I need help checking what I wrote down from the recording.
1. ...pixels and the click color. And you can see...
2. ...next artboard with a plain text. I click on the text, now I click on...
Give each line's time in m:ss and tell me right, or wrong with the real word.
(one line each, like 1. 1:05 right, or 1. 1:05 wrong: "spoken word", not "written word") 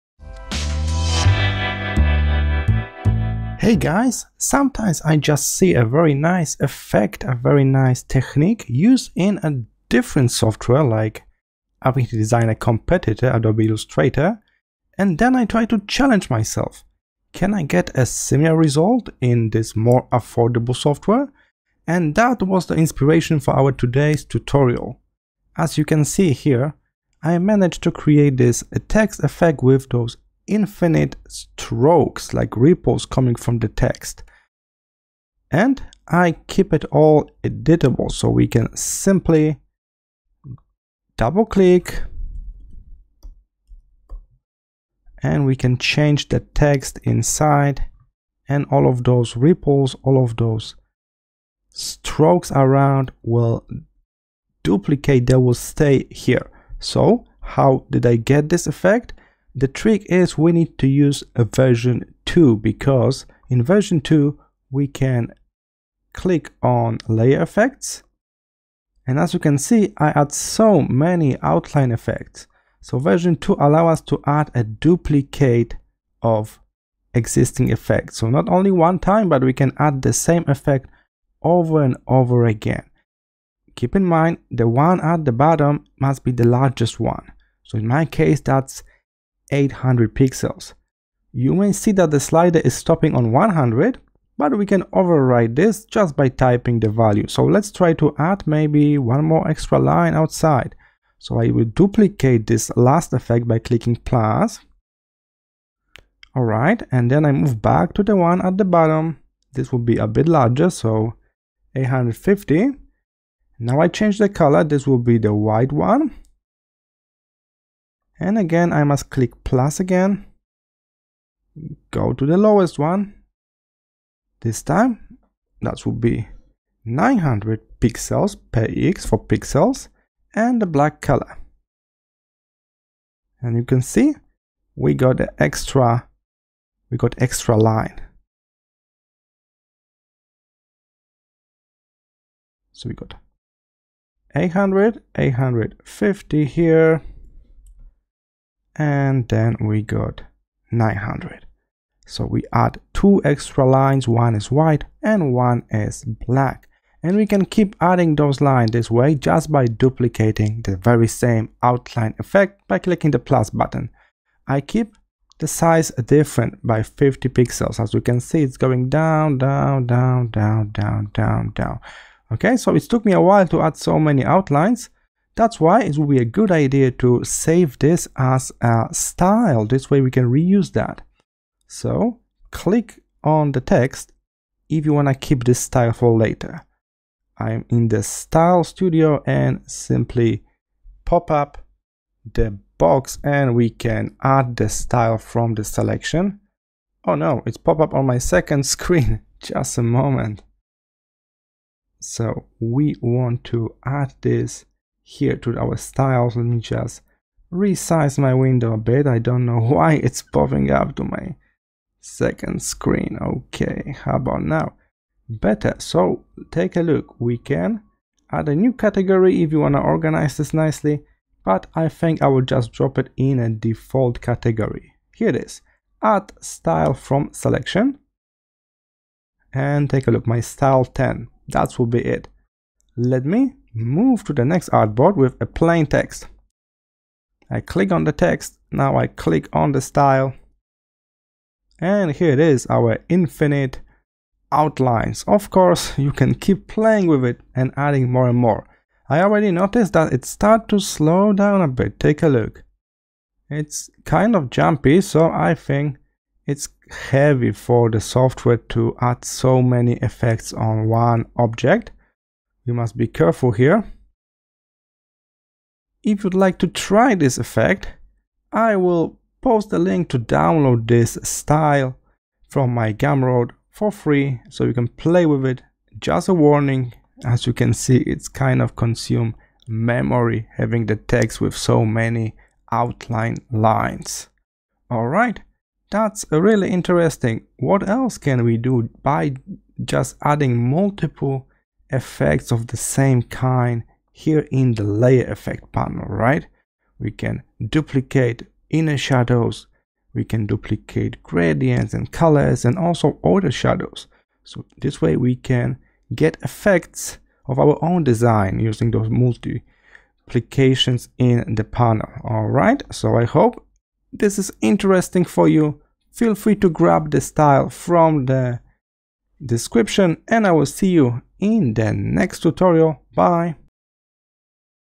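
1. 2:09 wrong: "black", not "click"
2. 3:54 right.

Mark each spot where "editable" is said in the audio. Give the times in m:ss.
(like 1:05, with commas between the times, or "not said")
0:37.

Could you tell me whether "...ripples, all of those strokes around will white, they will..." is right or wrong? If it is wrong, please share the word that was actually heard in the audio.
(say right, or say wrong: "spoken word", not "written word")
wrong: "duplicate", not "white".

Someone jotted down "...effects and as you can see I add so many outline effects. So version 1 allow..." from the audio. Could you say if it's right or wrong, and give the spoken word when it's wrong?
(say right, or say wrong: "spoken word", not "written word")
wrong: "2", not "1".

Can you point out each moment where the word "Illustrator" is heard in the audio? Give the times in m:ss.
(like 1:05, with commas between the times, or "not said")
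0:13.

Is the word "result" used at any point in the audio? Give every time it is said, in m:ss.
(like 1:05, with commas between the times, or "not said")
0:18.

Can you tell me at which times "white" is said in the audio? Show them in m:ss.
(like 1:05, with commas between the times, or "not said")
1:55, 2:34.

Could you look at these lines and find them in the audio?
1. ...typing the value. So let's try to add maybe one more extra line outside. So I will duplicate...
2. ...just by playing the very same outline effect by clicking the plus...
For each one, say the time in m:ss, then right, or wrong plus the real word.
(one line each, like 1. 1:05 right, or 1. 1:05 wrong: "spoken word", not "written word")
1. 1:36 right
2. 2:39 wrong: "duplicating", not "playing".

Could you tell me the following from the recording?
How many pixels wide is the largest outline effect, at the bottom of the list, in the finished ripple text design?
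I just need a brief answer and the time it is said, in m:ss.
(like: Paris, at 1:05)
800 pixels, at 1:29.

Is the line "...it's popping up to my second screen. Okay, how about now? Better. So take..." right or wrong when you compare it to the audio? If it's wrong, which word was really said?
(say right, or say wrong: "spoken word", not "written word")
right.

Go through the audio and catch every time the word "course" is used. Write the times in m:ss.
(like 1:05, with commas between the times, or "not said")
4:05.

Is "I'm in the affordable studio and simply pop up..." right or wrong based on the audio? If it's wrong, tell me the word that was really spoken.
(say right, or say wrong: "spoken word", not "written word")
wrong: "style", not "affordable".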